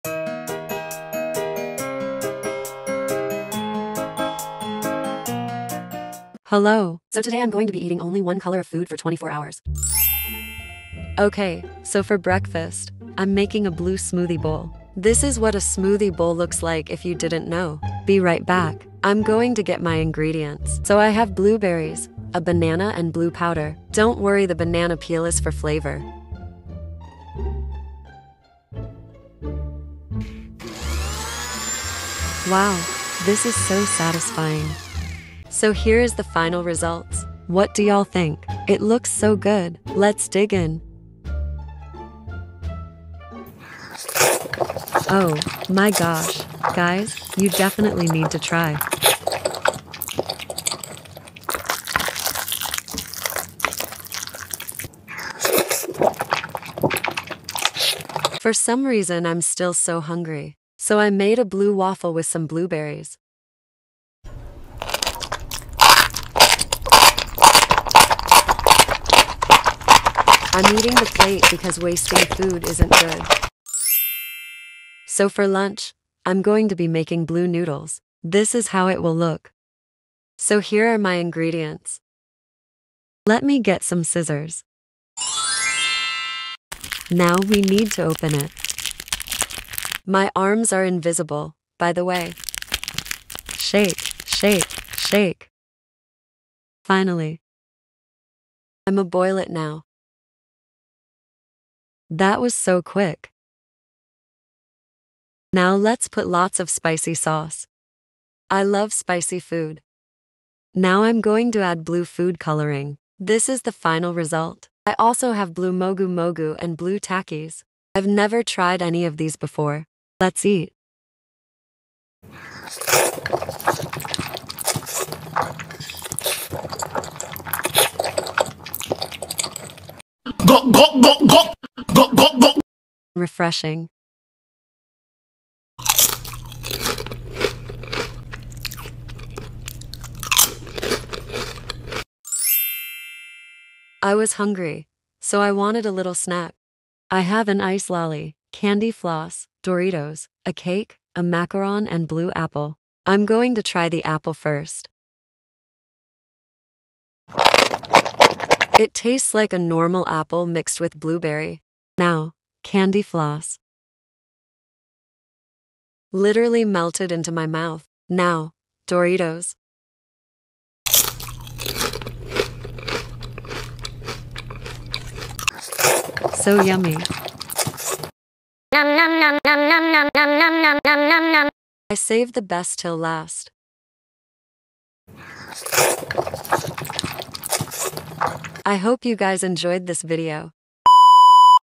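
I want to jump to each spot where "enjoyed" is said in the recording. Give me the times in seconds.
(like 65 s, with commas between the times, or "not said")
189 s.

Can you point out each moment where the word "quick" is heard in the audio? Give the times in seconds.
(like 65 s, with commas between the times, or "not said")
102 s.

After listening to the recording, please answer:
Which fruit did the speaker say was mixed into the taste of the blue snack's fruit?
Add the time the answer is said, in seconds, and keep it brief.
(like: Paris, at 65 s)
blueberry, at 160 s.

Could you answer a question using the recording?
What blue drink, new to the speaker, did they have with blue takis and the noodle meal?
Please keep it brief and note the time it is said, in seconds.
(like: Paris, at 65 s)
mogu mogu, at 115 s.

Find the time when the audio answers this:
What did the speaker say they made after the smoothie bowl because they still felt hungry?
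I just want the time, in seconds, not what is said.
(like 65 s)
61 s.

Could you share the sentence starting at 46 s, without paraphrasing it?
Guys, you definitely need to try.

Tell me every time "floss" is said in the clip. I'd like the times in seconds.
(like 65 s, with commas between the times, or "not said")
148 s, 163 s.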